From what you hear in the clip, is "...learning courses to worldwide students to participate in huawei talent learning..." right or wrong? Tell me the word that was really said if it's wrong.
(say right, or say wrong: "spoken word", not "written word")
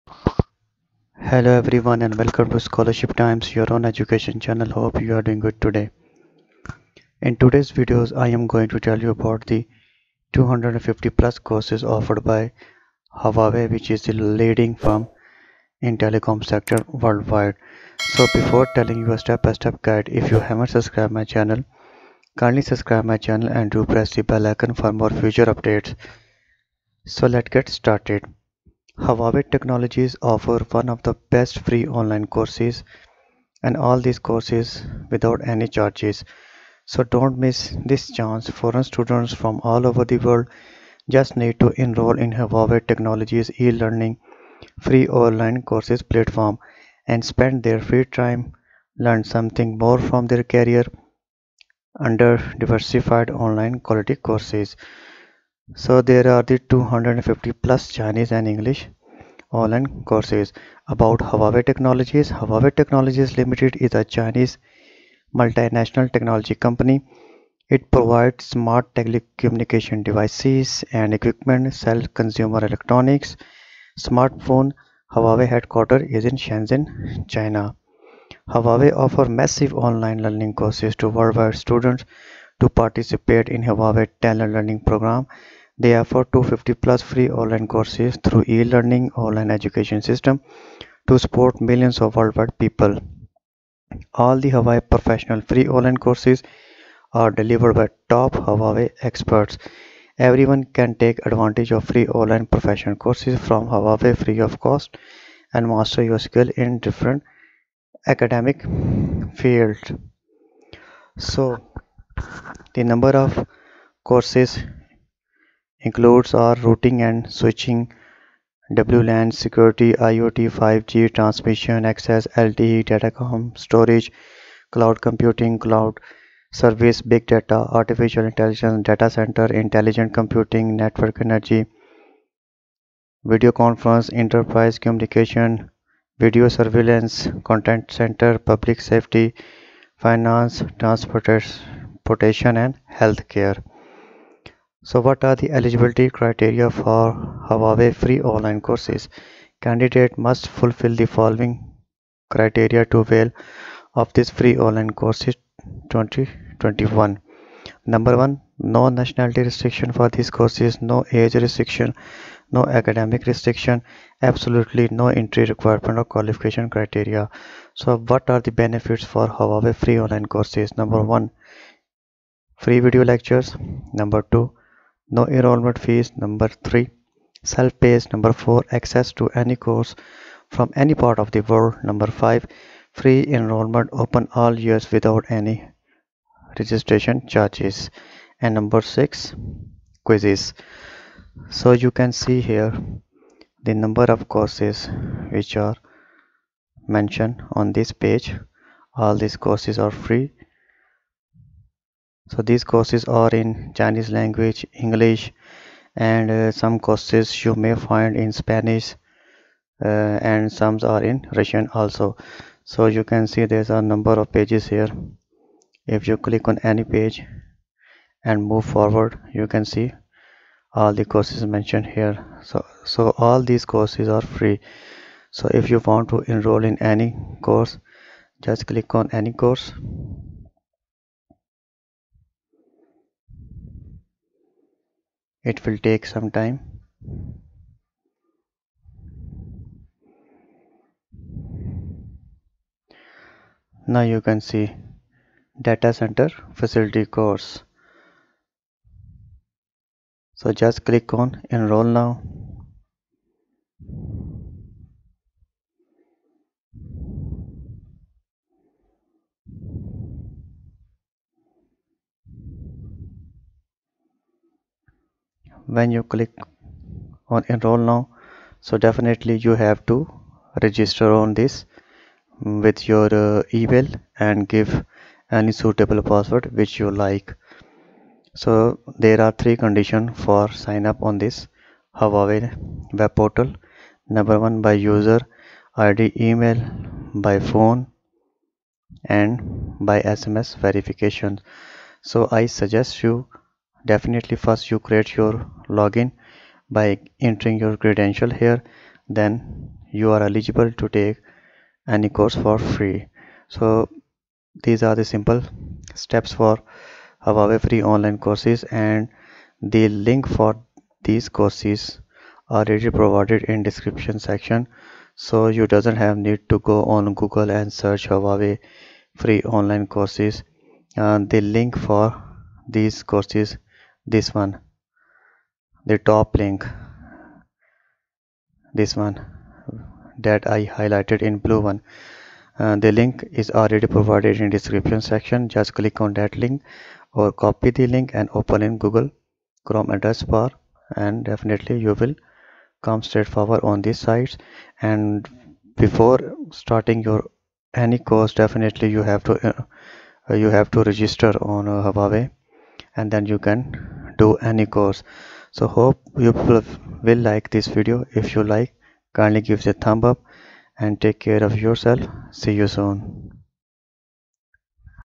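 right.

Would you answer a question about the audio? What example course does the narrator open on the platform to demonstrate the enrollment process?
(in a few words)
Data center facility.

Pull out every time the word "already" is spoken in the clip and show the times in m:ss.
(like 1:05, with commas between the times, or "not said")
5:12, 5:33.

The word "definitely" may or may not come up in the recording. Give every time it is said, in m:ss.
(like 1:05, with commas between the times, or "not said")
4:28, 4:53, 5:41, 5:48.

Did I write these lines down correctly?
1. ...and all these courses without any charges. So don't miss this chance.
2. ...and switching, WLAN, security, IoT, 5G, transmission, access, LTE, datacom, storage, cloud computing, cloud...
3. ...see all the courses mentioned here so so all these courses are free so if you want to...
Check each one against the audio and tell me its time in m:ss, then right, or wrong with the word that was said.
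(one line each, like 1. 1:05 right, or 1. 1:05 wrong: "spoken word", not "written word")
1. 0:33 right
2. 1:57 right
3. 3:39 right.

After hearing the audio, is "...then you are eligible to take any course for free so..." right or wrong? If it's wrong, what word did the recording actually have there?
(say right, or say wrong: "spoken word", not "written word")
right.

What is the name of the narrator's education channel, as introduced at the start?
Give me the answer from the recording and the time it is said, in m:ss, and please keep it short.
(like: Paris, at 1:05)
Scholarship Times, at 0:02.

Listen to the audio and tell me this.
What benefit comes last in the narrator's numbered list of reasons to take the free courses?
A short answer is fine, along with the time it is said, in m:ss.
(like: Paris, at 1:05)
Quizzes, at 3:10.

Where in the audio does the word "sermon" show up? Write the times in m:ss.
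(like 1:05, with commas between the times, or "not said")
not said.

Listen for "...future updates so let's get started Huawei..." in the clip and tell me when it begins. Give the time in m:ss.
0:25.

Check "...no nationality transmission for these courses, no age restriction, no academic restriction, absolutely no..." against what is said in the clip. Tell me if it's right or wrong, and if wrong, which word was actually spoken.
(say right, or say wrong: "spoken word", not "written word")
wrong: "restriction", not "transmission".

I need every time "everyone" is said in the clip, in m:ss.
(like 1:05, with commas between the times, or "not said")
0:01, 1:40.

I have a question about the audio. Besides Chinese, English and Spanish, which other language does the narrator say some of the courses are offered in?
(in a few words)
Russian.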